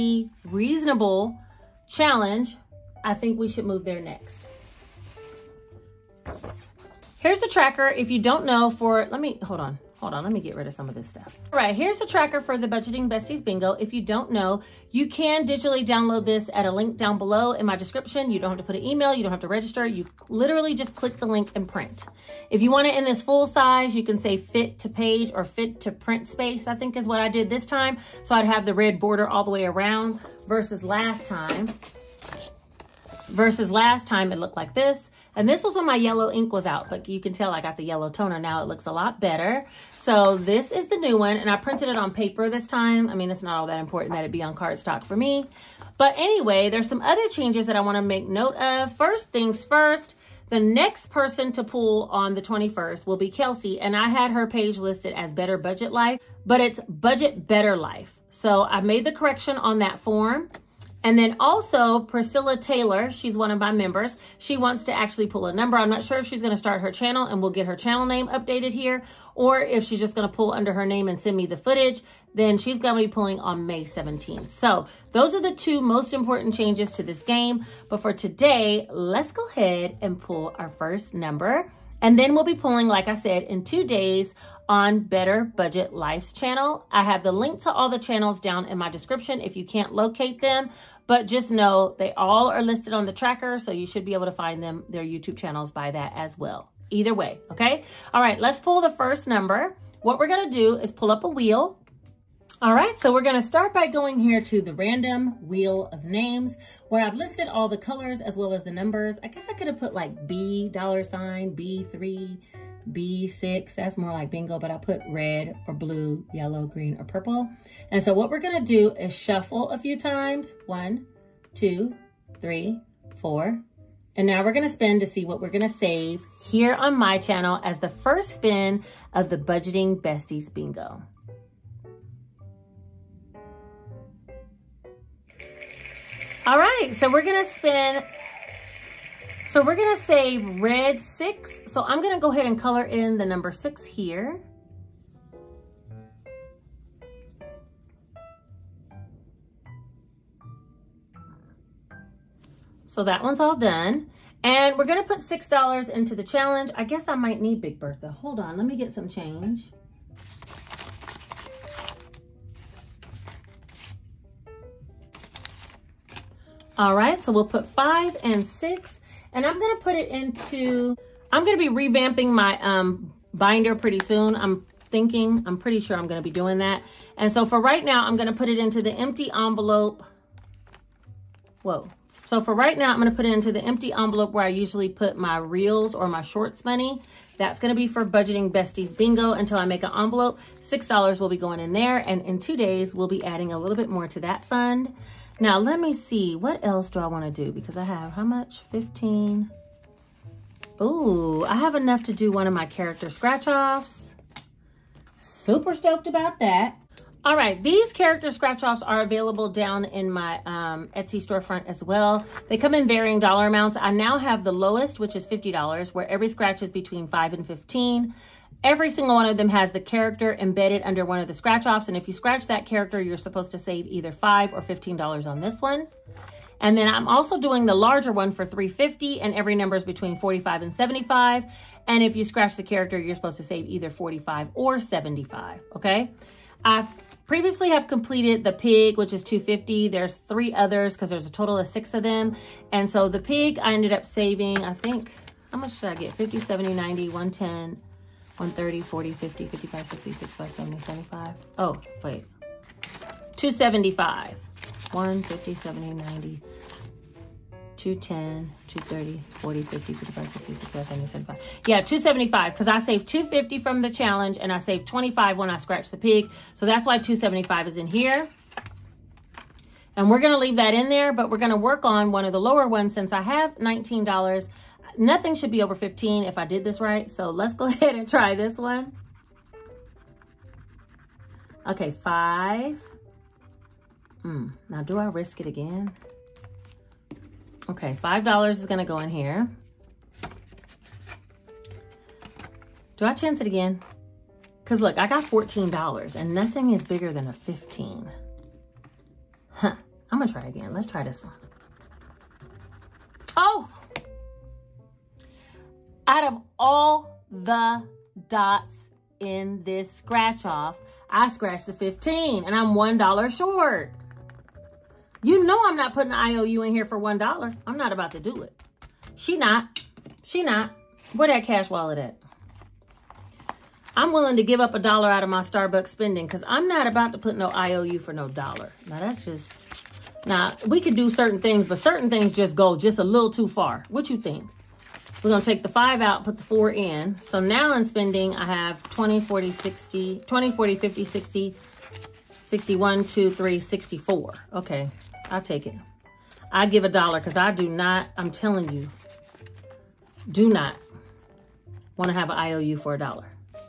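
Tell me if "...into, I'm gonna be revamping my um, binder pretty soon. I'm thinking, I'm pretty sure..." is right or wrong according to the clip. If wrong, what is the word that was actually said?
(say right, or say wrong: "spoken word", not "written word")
right.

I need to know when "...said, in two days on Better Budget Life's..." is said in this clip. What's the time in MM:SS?
01:23.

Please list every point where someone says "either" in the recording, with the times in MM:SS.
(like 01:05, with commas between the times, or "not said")
01:36, 03:43, 03:53.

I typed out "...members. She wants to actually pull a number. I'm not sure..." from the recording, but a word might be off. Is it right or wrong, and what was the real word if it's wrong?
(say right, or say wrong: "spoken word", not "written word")
right.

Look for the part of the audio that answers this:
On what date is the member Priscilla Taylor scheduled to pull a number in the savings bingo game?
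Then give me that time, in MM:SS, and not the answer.
01:13.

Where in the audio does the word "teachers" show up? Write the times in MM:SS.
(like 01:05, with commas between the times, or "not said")
not said.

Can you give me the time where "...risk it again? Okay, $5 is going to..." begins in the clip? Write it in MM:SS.
04:45.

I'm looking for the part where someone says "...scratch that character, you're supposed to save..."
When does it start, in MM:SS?
03:42.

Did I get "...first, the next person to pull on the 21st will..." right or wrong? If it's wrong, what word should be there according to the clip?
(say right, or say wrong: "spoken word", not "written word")
right.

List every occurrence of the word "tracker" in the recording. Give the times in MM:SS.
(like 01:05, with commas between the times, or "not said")
00:07, 00:12, 01:33.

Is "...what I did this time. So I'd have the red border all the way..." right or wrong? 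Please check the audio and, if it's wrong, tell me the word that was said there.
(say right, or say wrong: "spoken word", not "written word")
right.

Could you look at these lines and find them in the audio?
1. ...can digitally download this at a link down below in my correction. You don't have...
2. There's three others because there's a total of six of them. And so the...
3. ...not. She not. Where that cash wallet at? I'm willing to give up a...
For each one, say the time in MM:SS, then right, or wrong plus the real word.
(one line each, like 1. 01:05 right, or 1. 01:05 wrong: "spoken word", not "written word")
1. 00:15 wrong: "description", not "correction"
2. 03:59 right
3. 05:19 right.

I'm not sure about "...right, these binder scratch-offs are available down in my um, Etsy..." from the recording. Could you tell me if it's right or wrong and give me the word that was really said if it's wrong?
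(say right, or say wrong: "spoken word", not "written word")
wrong: "character", not "binder".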